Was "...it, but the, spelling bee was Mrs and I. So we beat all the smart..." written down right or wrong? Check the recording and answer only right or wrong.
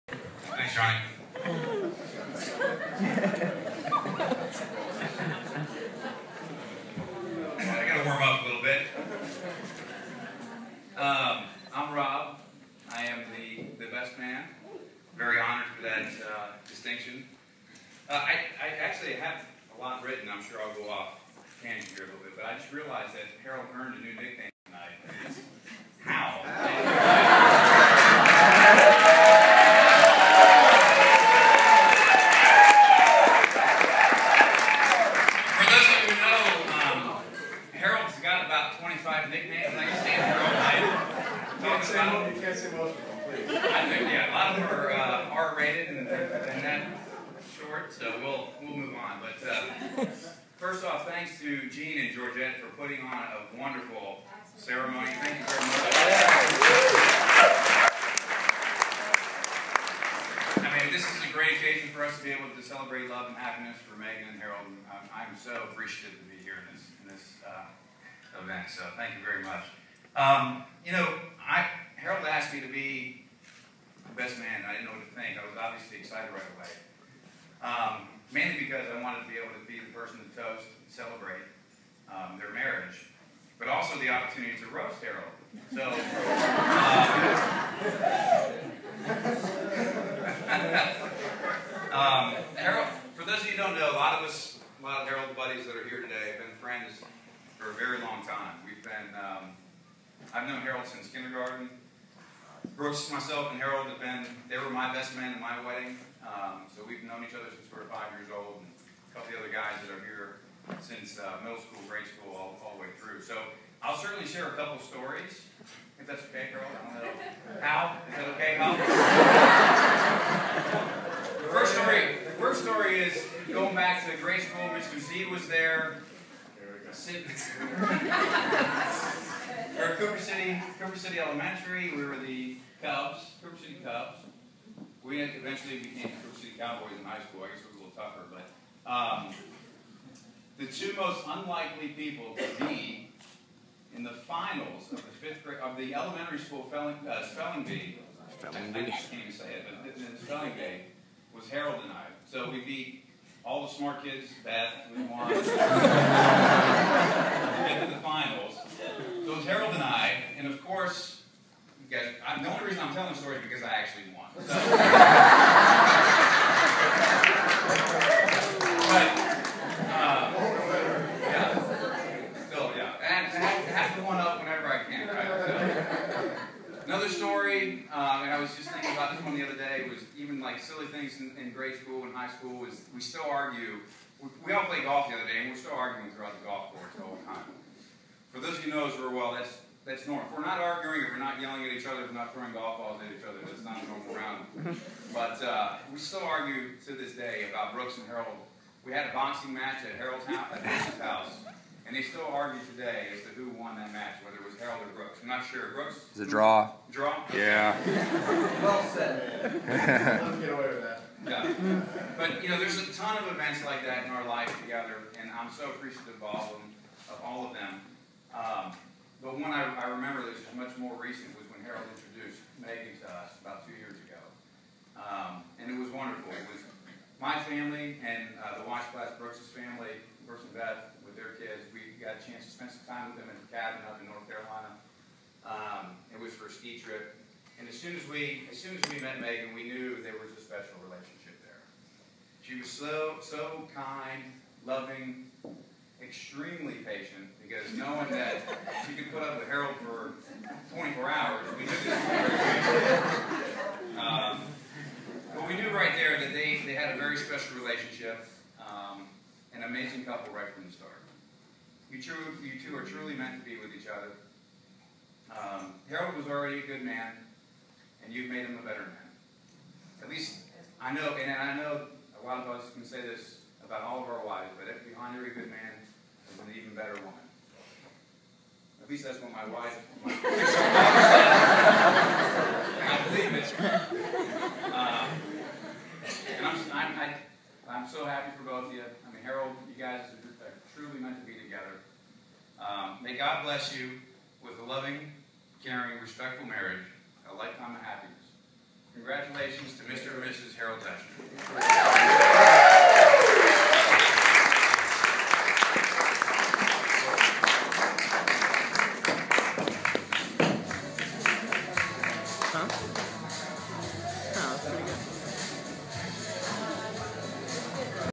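wrong.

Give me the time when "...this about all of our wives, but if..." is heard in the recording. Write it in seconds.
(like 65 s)
273 s.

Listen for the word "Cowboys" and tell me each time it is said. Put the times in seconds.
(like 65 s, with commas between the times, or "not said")
136 s.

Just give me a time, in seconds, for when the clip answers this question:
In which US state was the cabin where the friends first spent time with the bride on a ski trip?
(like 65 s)
234 s.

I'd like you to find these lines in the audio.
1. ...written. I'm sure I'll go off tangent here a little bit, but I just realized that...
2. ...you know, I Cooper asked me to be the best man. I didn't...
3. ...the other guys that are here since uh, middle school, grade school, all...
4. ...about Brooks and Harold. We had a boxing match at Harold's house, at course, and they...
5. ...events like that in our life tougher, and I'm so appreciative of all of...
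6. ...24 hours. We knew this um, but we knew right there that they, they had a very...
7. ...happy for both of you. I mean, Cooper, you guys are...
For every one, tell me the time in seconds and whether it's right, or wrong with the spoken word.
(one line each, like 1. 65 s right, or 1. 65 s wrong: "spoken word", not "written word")
1. 20 s right
2. 70 s wrong: "Harold", not "Cooper"
3. 109 s right
4. 197 s wrong: "house", not "course"
5. 213 s wrong: "together", not "tougher"
6. 250 s right
7. 288 s wrong: "Harold", not "Cooper".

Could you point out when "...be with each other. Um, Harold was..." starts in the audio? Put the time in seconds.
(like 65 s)
263 s.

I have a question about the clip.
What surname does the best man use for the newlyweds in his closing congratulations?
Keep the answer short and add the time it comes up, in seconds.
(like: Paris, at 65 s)
Dutchman, at 300 s.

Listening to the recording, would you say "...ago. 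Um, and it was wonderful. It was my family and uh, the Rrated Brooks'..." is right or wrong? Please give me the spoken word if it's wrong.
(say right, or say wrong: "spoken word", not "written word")
wrong: "Weisblat", not "Rrated".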